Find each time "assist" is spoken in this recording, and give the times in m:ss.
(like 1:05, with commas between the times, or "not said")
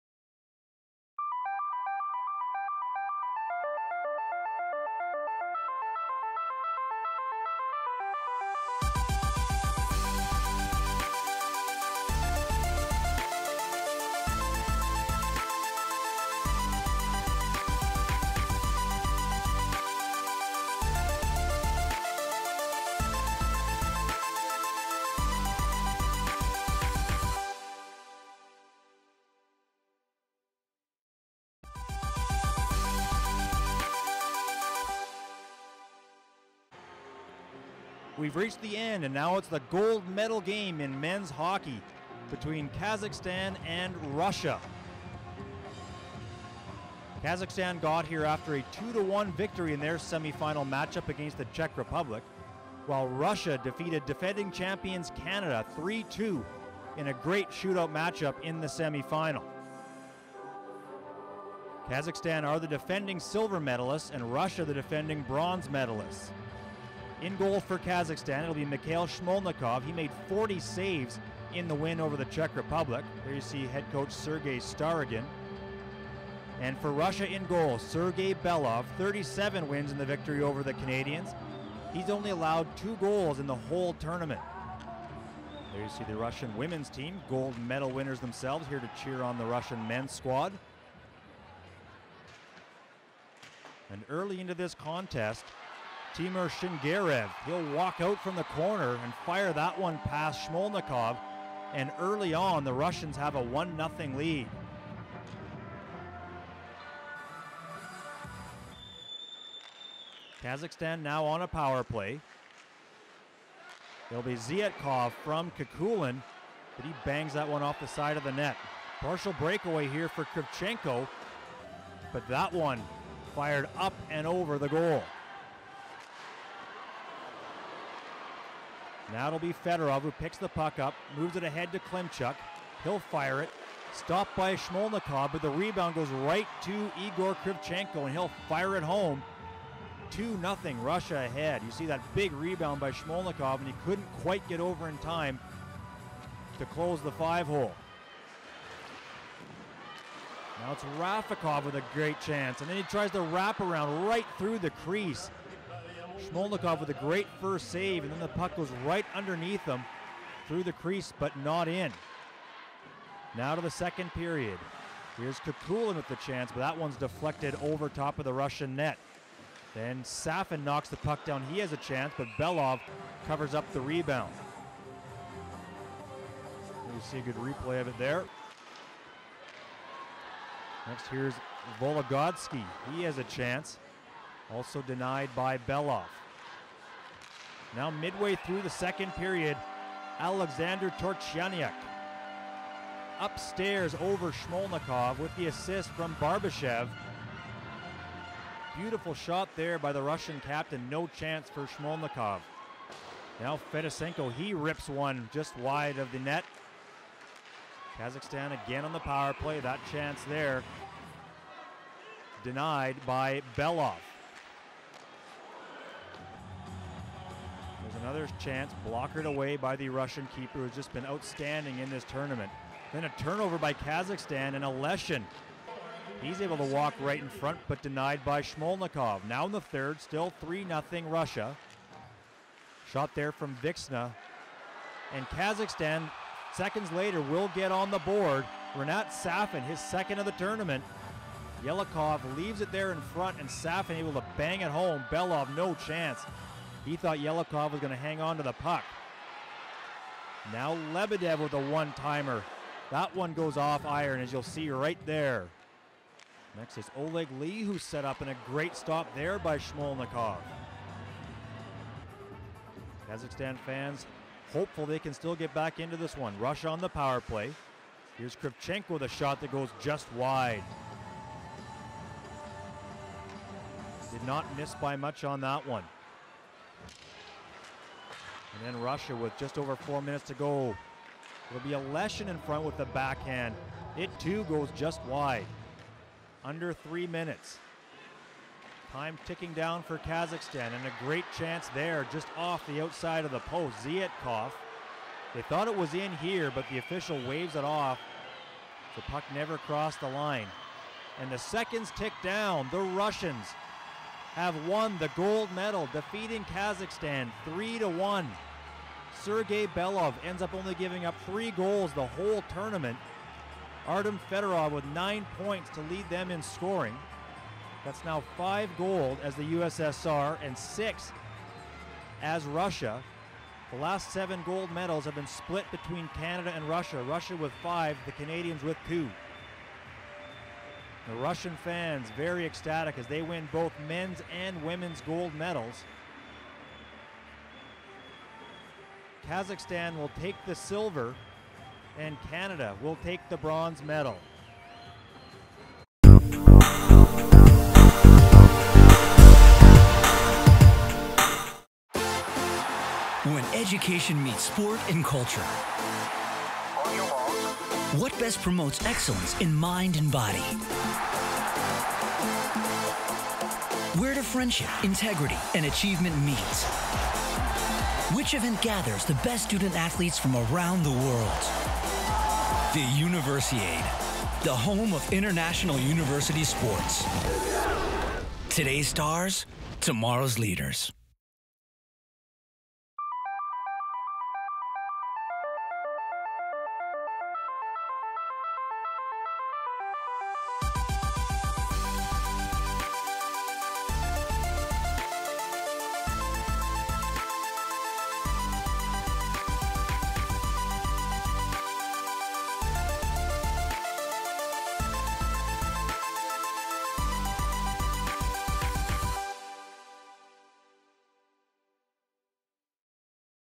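3:15.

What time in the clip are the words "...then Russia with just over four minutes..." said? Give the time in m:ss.
4:38.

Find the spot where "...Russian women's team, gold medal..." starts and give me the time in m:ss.
1:26.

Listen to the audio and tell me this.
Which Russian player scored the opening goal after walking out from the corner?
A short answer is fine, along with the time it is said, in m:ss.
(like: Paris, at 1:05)
Timur Shingarev, at 1:36.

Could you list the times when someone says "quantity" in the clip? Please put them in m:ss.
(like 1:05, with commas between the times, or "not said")
not said.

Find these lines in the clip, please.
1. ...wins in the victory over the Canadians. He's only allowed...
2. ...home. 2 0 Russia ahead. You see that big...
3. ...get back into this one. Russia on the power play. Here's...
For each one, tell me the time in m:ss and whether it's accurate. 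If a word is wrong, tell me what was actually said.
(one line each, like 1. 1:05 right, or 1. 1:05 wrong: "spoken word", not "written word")
1. 1:19 right
2. 2:18 right
3. 4:25 right.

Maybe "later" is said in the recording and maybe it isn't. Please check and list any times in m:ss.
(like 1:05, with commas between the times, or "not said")
3:56.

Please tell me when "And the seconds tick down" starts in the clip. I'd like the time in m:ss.
5:01.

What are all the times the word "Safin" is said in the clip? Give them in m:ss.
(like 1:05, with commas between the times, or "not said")
2:50, 3:59, 4:03.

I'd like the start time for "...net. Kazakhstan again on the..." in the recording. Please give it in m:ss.
3:26.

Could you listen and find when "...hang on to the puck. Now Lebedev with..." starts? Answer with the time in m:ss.
4:07.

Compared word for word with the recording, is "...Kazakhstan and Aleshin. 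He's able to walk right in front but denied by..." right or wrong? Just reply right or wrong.
right.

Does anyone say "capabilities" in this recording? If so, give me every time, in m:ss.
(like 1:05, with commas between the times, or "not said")
not said.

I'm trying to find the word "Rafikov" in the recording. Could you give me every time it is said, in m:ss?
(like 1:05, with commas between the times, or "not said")
2:30.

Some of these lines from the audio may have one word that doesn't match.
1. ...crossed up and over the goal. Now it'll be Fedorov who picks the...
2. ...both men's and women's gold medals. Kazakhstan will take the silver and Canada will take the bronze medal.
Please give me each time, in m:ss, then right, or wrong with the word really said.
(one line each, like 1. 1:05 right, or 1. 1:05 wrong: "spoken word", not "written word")
1. 2:03 wrong: "fired", not "crossed"
2. 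5:33 right.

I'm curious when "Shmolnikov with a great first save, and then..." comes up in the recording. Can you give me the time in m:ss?
2:36.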